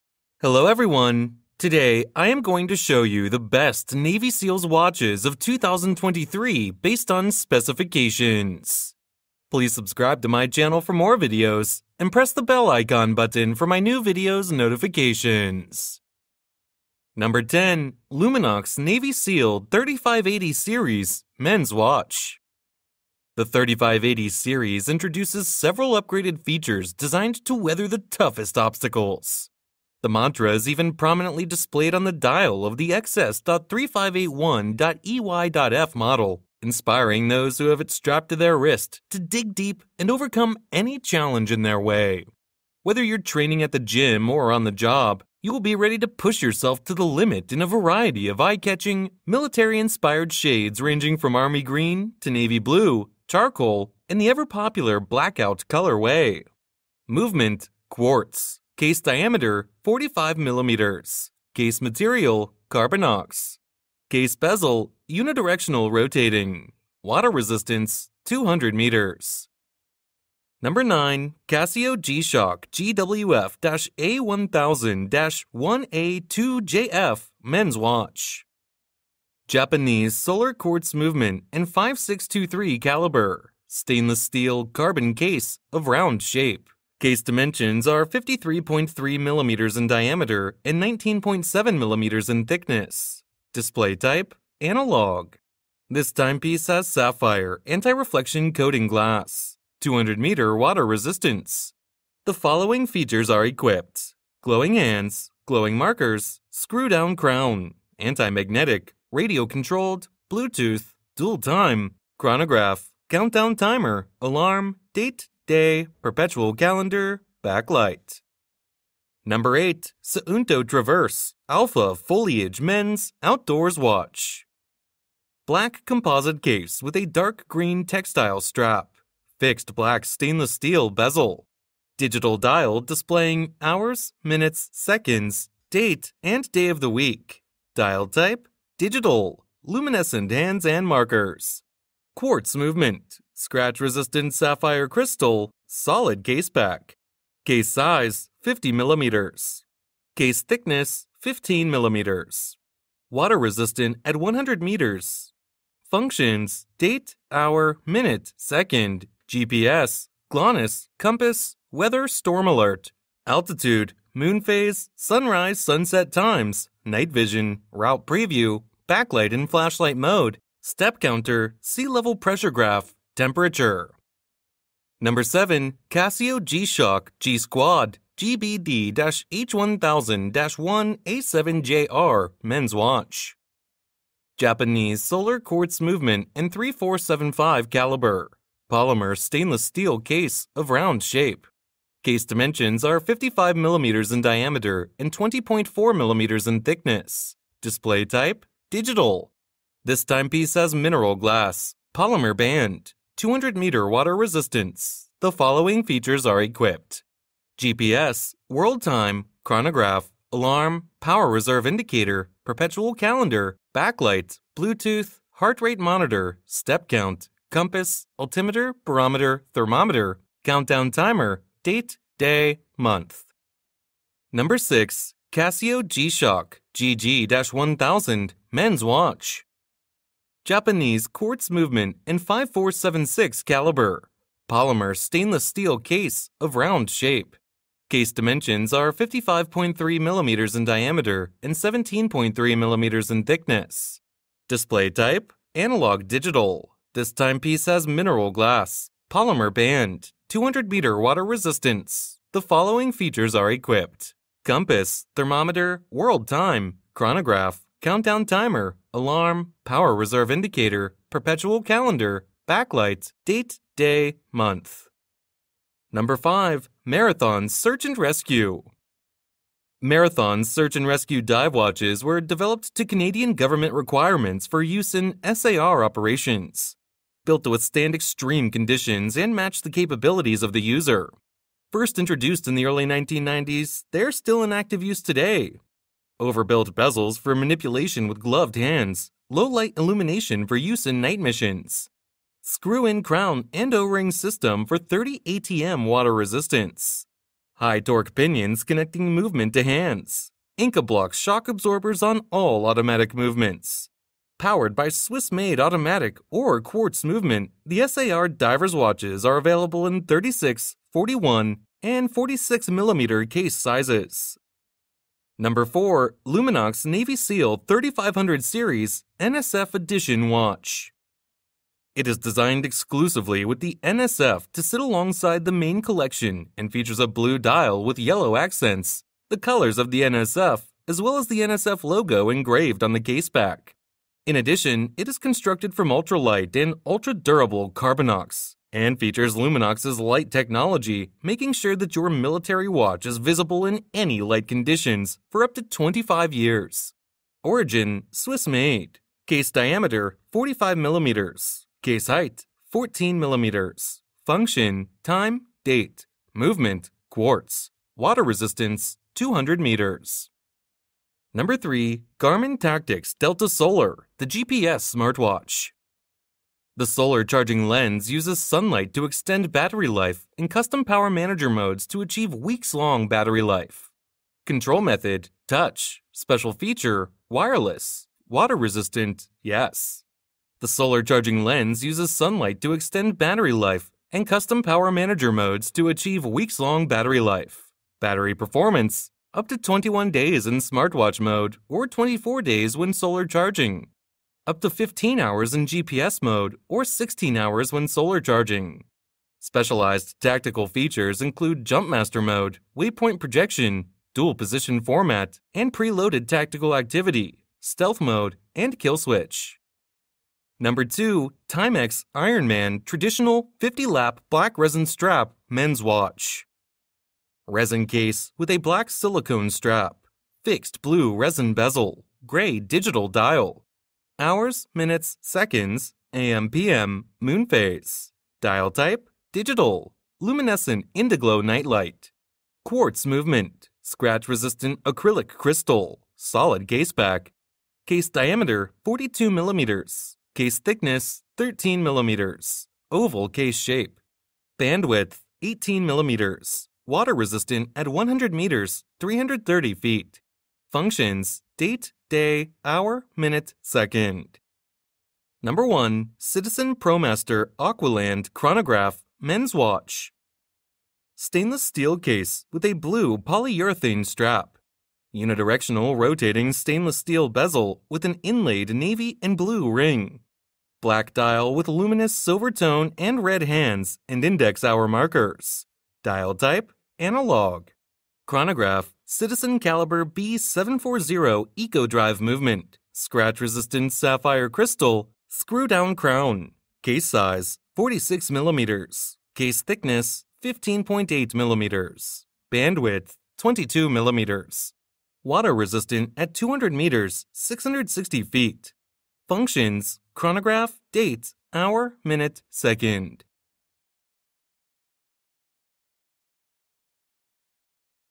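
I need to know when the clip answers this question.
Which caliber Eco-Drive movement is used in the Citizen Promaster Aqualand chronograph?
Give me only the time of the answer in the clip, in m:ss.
8:00.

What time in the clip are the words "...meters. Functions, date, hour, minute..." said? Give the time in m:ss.
2:34.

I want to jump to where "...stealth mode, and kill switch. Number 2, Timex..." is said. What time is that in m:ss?
6:47.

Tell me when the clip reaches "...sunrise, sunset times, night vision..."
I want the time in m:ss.
2:44.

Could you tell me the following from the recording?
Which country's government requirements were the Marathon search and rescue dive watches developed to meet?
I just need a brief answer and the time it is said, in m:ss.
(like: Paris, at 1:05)
Canadian, at 4:32.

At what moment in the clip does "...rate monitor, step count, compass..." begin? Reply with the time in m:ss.
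3:35.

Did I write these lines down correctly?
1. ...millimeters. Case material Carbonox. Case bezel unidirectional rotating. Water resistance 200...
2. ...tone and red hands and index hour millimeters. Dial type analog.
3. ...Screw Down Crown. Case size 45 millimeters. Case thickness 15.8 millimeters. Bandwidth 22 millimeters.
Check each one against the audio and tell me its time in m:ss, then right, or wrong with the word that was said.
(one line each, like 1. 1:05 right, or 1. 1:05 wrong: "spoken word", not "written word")
1. 1:00 right
2. 7:52 wrong: "markers", not "millimeters"
3. 8:05 wrong: "46", not "45".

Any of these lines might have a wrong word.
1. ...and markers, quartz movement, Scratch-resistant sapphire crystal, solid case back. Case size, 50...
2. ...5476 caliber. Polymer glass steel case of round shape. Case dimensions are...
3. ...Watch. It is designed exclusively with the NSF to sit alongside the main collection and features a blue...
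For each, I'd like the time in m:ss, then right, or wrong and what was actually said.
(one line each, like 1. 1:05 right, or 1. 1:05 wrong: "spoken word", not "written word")
1. 2:20 right
2. 3:52 wrong: "stainless", not "glass"
3. 5:20 right.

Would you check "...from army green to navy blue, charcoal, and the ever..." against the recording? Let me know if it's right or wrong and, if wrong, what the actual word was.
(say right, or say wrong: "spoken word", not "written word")
right.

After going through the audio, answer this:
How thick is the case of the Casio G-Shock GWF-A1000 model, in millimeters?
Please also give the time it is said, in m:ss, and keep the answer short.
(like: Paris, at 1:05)
19.7, at 1:30.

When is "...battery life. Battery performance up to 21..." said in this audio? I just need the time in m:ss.
6:26.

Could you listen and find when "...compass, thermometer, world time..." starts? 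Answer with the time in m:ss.
4:14.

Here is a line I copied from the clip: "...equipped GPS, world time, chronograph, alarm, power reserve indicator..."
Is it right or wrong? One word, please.
right.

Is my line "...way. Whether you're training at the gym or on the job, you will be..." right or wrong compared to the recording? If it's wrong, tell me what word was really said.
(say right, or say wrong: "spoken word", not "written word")
right.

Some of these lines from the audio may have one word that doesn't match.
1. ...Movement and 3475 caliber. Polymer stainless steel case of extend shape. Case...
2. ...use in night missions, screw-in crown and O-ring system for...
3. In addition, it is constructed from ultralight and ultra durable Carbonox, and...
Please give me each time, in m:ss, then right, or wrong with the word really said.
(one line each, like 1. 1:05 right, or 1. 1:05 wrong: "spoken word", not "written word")
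1. 3:05 wrong: "round", not "extend"
2. 4:50 right
3. 5:34 right.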